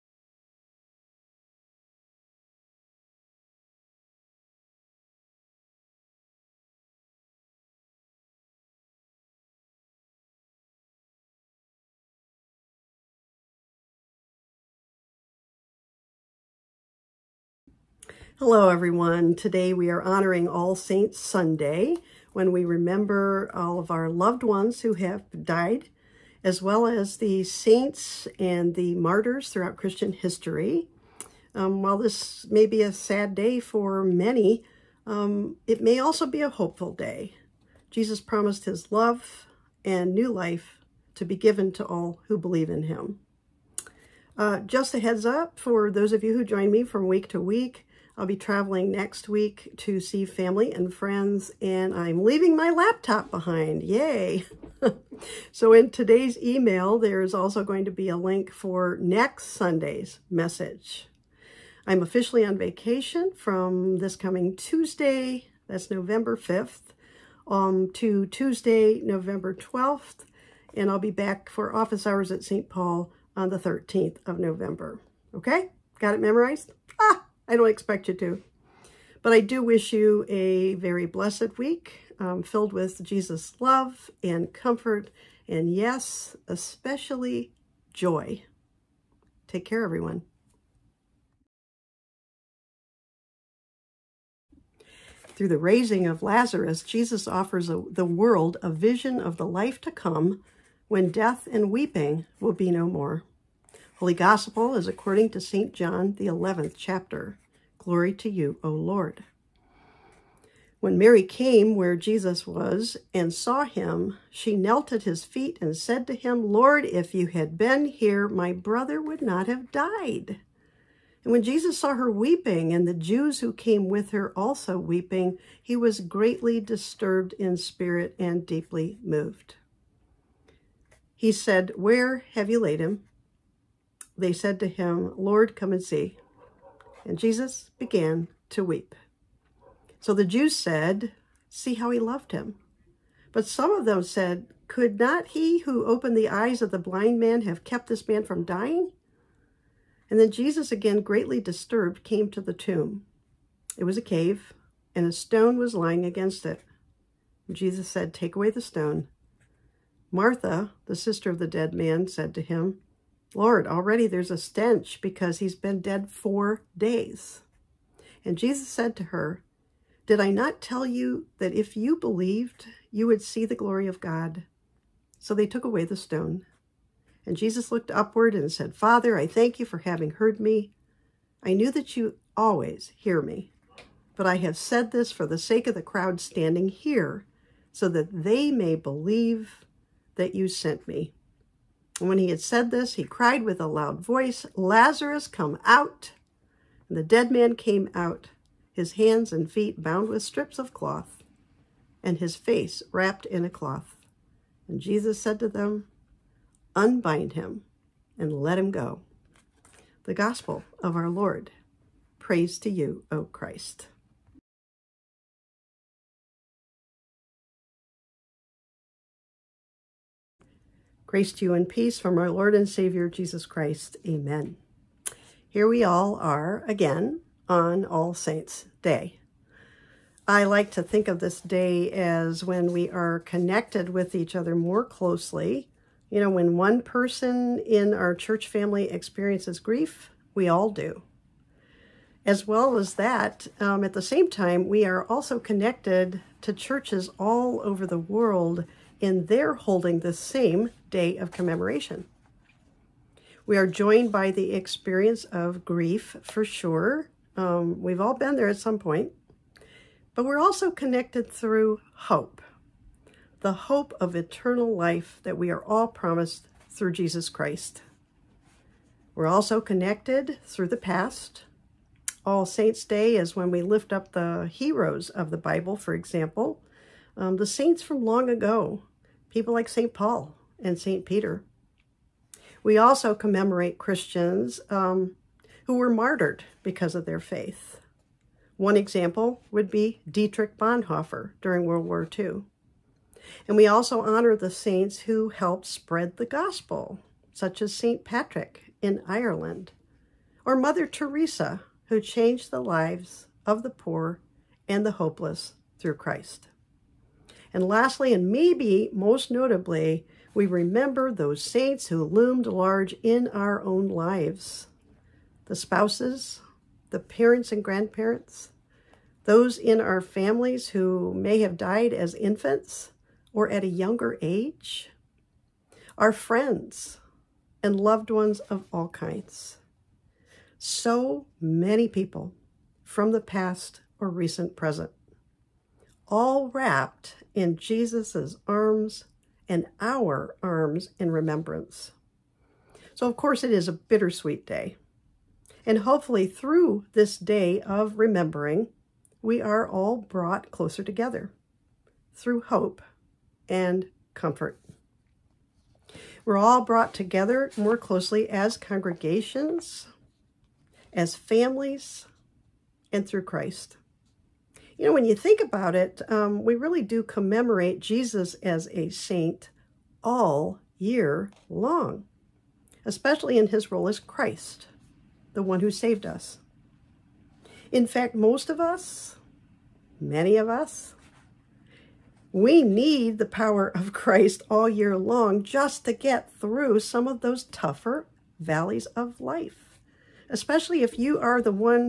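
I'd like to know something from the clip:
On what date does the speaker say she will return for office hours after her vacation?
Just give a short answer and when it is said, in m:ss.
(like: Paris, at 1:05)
November 13, at 1:13.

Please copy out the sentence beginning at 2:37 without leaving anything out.
Jesus said, Take away the stone.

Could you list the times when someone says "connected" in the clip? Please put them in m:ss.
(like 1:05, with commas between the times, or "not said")
3:53, 4:05, 4:20, 4:29.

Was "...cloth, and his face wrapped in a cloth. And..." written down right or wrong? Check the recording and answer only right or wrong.
right.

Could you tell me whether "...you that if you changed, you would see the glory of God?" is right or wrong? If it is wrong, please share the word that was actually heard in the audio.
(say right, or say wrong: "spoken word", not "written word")
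wrong: "believed", not "changed".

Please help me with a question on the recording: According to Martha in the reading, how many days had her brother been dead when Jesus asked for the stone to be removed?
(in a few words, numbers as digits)
4.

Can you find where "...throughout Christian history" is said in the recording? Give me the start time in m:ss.
0:29.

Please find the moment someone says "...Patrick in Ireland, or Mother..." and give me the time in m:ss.
4:58.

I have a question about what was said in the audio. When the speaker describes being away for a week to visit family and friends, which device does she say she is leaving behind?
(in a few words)
laptop.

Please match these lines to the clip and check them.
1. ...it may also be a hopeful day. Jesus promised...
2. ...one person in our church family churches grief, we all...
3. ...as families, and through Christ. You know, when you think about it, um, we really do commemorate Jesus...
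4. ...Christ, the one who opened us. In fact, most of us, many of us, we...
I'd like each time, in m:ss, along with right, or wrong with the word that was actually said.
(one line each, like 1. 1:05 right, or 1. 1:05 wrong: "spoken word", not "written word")
1. 0:35 right
2. 3:56 wrong: "experiences", not "churches"
3. 6:00 right
4. 6:13 wrong: "saved", not "opened".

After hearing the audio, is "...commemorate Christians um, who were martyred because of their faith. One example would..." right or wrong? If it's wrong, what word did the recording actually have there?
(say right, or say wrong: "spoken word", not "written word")
right.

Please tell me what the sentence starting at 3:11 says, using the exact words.
And when he had said this, he cried with a loud voice, Lazarus, come out.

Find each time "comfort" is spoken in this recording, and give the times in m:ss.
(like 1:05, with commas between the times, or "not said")
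1:24, 5:54.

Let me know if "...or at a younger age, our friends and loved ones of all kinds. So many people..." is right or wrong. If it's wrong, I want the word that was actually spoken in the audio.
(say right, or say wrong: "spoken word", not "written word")
right.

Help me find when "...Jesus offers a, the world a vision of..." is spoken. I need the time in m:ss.
1:36.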